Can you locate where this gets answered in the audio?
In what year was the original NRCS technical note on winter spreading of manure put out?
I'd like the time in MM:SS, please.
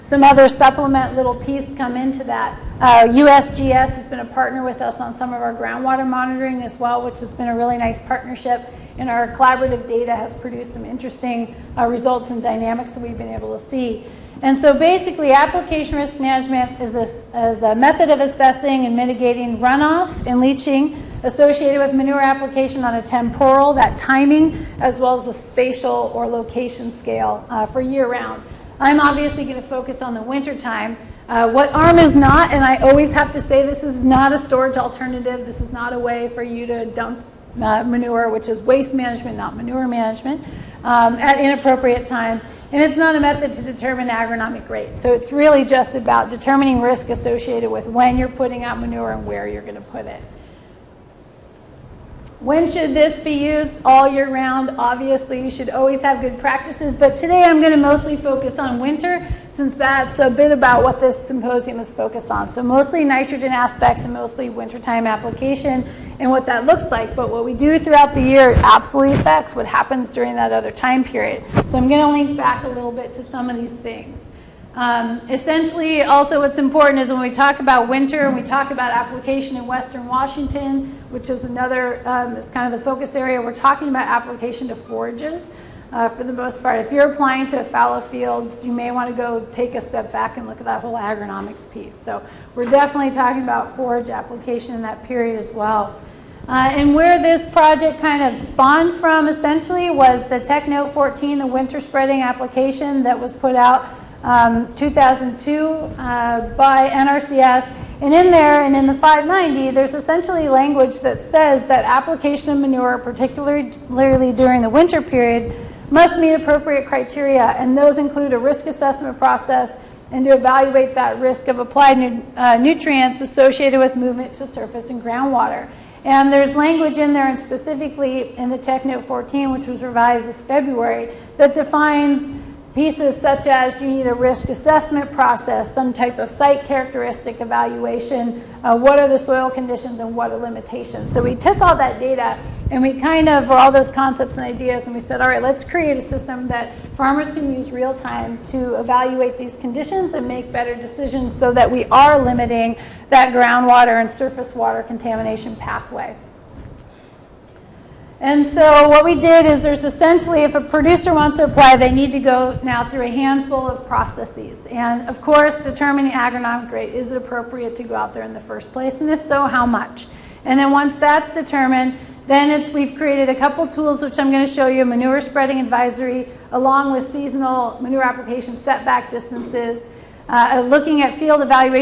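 01:44.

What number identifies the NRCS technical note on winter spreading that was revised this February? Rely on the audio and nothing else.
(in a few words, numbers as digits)
14.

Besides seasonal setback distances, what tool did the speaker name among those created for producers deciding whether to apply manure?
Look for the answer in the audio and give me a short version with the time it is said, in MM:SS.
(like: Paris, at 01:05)
manure spreading advisory, at 02:54.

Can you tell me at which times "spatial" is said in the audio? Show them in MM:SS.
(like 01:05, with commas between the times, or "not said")
00:25.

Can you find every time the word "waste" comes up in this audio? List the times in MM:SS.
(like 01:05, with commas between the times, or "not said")
00:38.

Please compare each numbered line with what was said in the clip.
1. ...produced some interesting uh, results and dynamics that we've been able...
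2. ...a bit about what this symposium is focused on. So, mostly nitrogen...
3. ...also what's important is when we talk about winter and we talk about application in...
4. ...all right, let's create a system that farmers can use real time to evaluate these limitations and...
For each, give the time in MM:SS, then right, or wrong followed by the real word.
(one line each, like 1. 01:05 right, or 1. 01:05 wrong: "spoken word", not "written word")
1. 00:10 right
2. 01:00 right
3. 01:16 right
4. 02:25 wrong: "conditions", not "limitations".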